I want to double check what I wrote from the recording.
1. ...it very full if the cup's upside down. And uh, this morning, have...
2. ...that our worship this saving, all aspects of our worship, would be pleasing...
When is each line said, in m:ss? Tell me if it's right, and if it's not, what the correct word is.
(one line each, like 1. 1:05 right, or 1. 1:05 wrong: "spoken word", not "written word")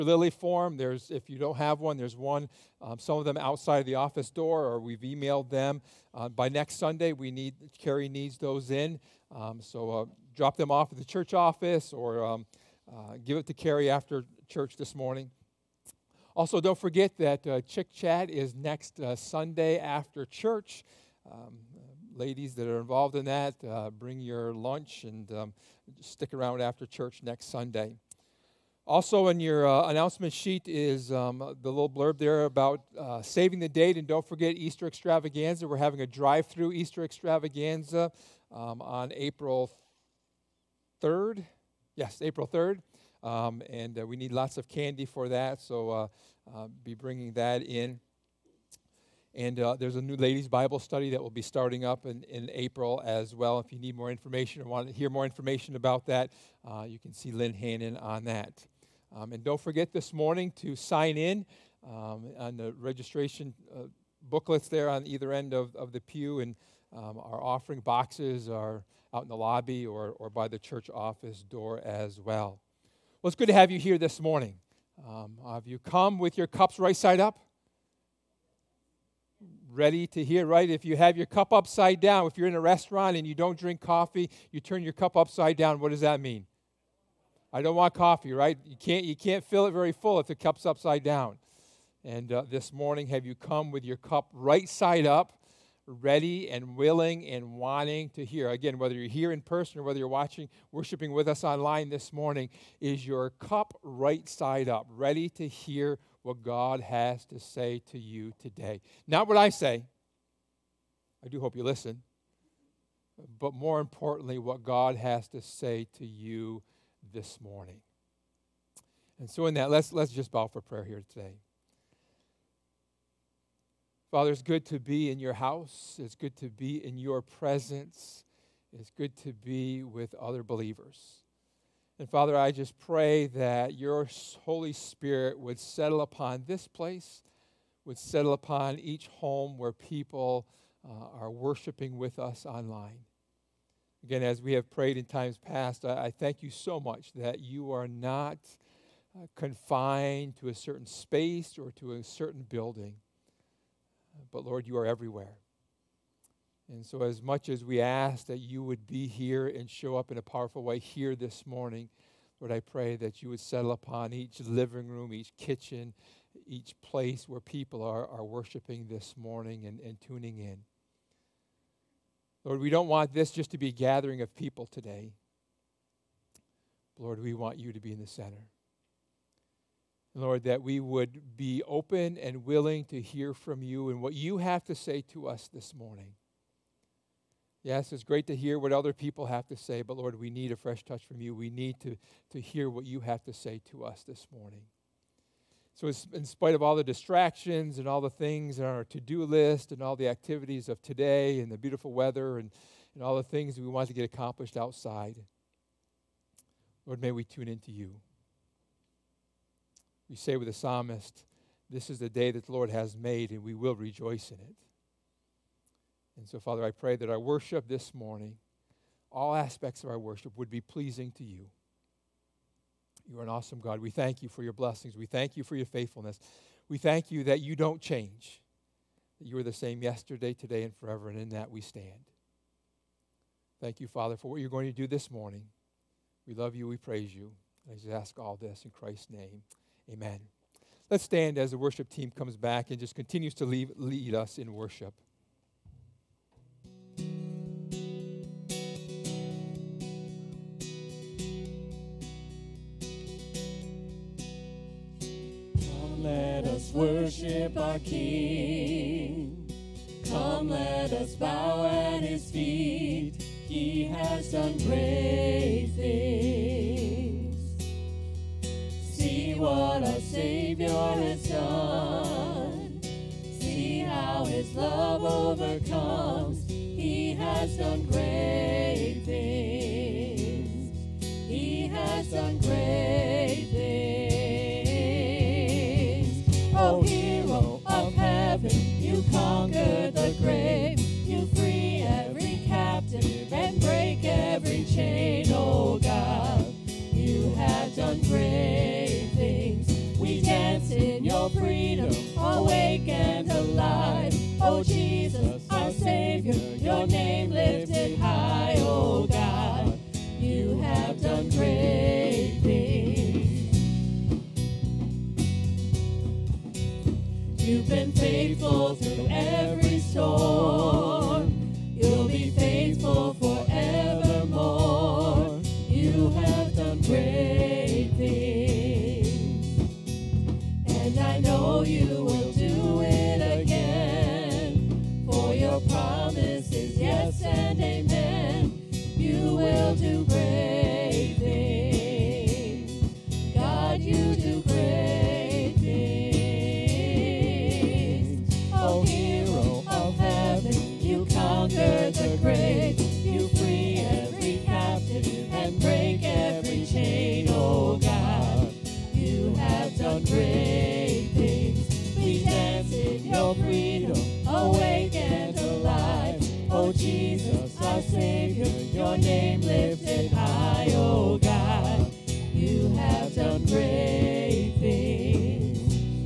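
1. 1:29 right
2. 3:36 wrong: "morning", not "saving".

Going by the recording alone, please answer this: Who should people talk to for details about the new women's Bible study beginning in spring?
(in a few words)
Lynn Hannon.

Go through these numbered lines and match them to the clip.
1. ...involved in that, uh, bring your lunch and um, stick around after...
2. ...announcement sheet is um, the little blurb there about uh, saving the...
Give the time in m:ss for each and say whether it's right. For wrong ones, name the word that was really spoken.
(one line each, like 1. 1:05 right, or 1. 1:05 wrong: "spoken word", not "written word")
1. 0:22 right
2. 0:29 right.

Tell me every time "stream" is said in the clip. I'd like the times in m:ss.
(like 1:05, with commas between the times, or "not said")
not said.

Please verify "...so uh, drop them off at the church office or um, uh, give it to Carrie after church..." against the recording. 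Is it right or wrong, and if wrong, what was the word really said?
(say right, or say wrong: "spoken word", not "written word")
right.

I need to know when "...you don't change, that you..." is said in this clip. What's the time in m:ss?
3:47.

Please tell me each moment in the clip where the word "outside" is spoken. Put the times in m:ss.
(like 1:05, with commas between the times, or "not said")
0:03, 3:24.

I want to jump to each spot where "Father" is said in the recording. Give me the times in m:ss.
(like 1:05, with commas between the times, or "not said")
2:04, 2:12, 3:36, 3:53.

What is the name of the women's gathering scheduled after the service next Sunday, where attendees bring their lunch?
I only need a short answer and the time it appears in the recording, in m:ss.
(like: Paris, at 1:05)
Chick Chat, at 0:17.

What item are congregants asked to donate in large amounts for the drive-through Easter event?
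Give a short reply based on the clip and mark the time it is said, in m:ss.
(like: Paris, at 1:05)
Candy, at 0:44.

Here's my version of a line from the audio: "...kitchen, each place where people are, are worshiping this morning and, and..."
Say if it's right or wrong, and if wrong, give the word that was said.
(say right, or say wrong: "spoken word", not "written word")
right.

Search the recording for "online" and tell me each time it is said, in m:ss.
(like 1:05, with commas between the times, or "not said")
1:41, 2:22.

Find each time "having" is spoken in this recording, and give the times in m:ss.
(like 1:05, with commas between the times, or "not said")
0:35.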